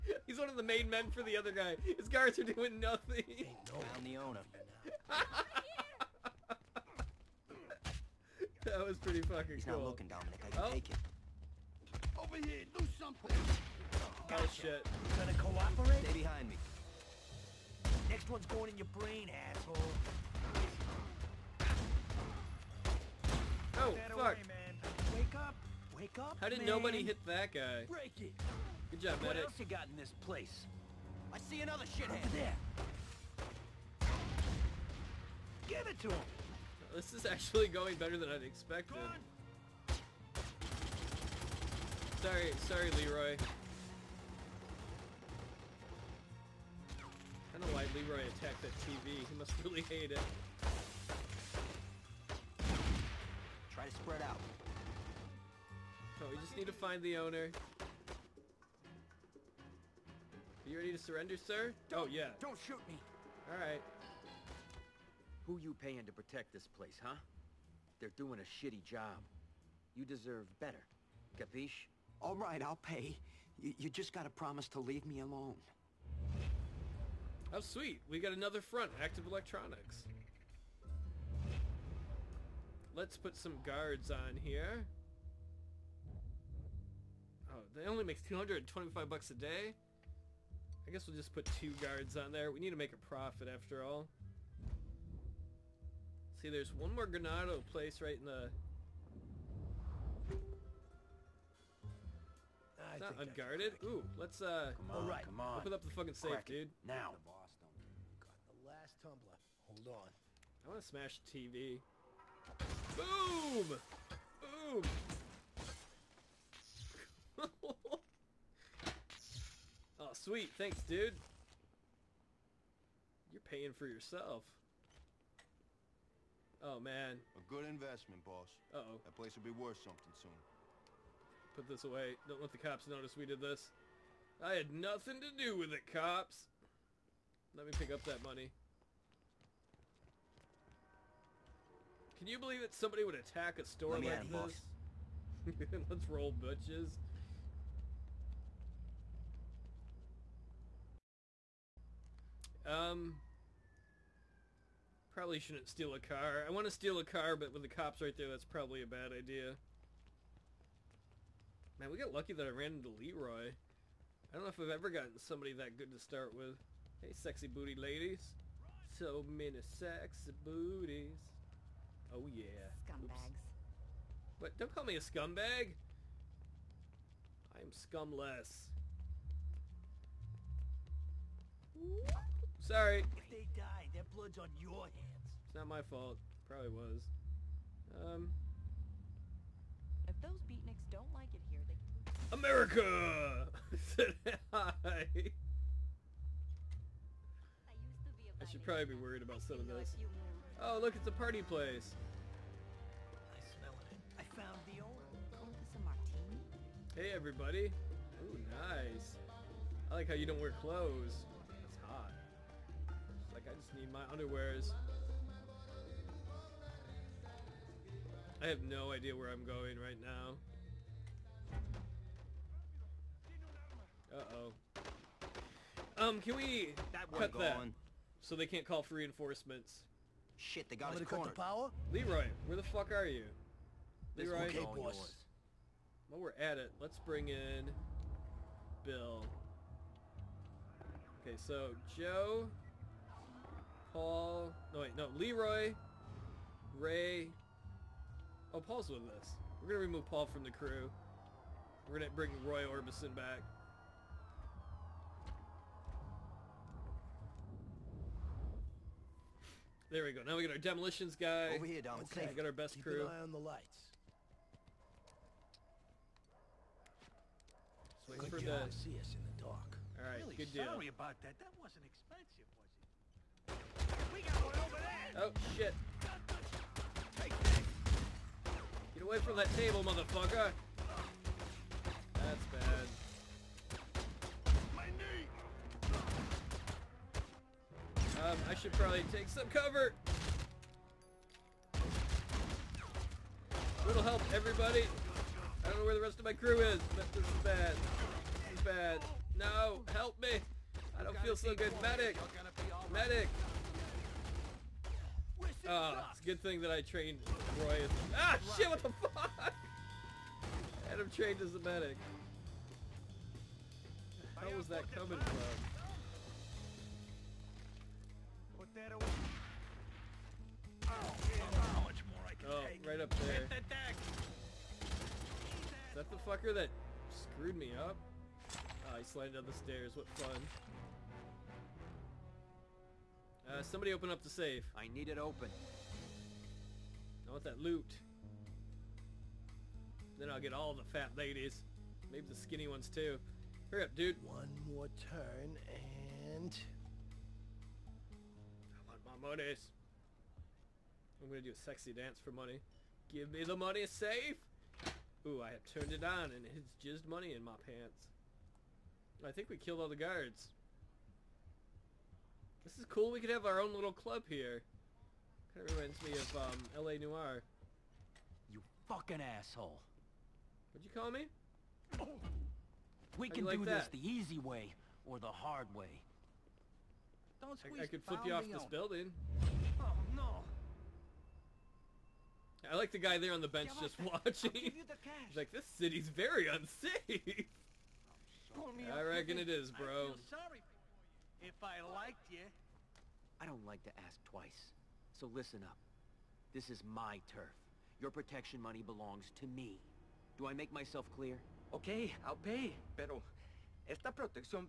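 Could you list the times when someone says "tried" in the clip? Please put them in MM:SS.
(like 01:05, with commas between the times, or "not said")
not said.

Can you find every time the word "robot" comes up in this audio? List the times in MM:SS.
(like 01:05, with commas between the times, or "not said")
not said.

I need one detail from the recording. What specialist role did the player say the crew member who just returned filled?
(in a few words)
Demolitions guy.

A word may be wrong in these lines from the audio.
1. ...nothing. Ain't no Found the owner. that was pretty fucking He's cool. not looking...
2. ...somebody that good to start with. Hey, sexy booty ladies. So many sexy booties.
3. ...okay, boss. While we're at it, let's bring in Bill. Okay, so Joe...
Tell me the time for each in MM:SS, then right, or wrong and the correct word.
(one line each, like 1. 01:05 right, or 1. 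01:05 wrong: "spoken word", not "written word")
1. 00:02 right
2. 02:45 right
3. 03:54 right.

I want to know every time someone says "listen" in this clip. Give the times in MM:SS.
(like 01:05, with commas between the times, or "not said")
06:35.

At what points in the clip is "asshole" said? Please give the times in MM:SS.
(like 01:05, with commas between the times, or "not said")
00:19, 06:09.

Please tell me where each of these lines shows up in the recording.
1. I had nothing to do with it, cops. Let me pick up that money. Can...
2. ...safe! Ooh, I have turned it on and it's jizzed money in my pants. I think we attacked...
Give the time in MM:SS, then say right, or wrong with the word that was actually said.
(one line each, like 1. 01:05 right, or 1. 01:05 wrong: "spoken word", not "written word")
1. 02:14 right
2. 05:53 wrong: "killed", not "attacked".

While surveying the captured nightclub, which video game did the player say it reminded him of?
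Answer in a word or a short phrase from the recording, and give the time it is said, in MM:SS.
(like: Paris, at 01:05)
L.A. Noire, at 06:06.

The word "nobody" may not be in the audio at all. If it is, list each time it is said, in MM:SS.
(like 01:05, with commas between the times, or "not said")
00:26.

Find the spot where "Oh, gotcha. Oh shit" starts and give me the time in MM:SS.
00:13.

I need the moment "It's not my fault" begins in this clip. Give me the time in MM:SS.
03:05.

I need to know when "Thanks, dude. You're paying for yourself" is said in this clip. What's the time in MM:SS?
02:00.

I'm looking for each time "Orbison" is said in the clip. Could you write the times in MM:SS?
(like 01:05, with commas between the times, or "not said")
04:12.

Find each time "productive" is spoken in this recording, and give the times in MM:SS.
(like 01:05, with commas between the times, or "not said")
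not said.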